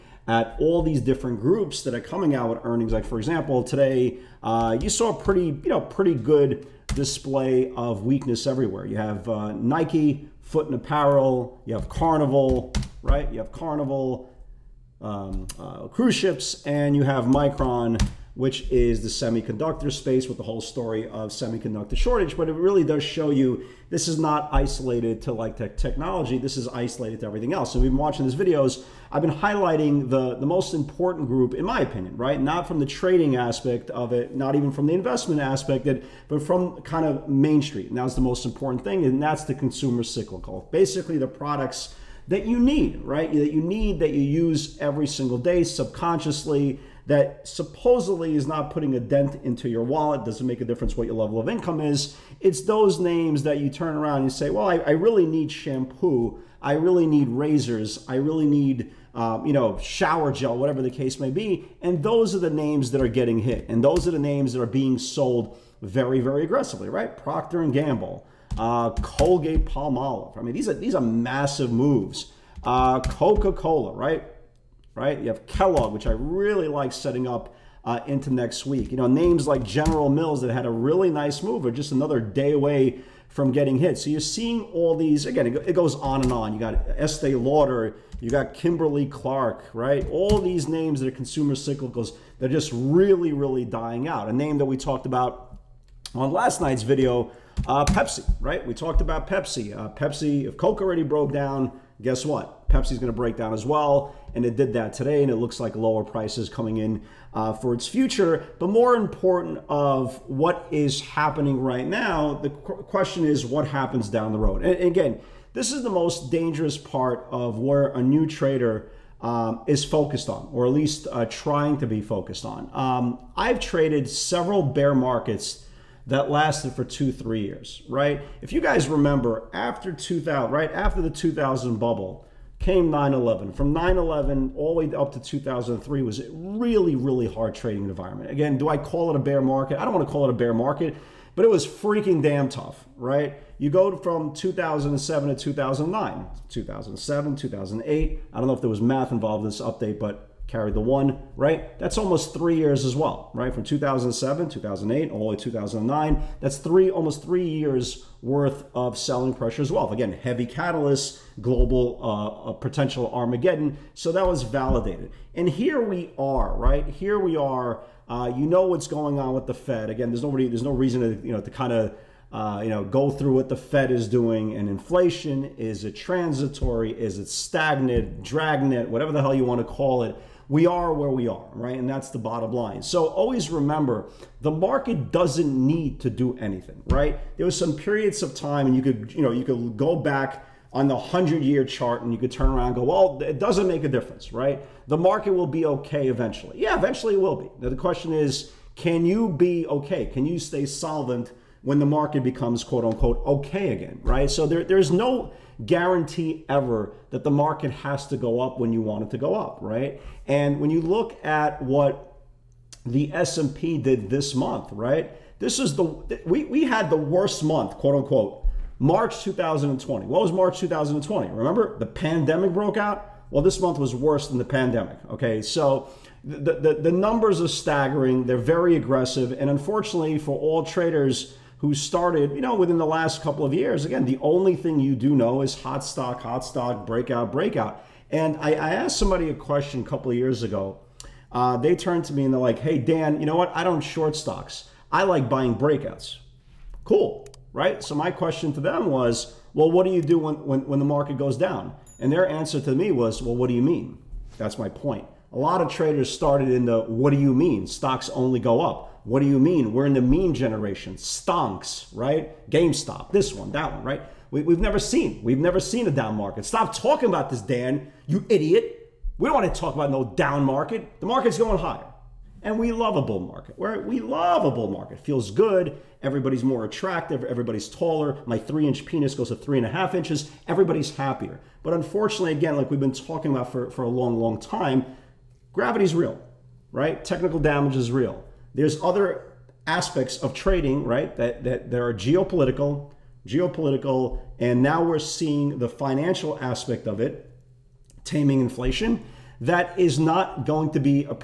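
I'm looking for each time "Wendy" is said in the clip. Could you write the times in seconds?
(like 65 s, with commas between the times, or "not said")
not said.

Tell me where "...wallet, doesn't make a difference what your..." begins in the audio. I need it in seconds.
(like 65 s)
49 s.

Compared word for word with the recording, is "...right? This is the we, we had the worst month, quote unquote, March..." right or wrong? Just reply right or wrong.
right.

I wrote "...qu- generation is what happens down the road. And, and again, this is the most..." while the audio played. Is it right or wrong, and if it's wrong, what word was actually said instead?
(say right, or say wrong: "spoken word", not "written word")
wrong: "question", not "generation".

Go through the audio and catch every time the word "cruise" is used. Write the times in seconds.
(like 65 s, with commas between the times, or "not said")
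15 s.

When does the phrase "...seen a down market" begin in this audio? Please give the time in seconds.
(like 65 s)
265 s.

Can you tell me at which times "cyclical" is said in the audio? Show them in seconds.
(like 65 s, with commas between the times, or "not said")
40 s, 91 s.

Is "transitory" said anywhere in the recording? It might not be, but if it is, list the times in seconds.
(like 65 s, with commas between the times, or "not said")
175 s.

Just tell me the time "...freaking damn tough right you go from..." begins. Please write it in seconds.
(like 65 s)
141 s.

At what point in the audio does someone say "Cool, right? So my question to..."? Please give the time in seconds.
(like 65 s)
246 s.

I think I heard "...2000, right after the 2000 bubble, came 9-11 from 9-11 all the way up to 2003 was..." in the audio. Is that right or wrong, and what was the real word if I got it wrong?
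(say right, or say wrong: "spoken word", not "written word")
right.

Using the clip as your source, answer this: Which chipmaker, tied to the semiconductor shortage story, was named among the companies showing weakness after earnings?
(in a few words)
Micron.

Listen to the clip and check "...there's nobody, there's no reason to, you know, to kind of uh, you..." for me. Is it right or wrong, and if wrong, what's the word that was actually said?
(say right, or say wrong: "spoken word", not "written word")
right.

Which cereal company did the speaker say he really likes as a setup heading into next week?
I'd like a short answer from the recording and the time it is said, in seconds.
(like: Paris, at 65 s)
Kellogg, at 75 s.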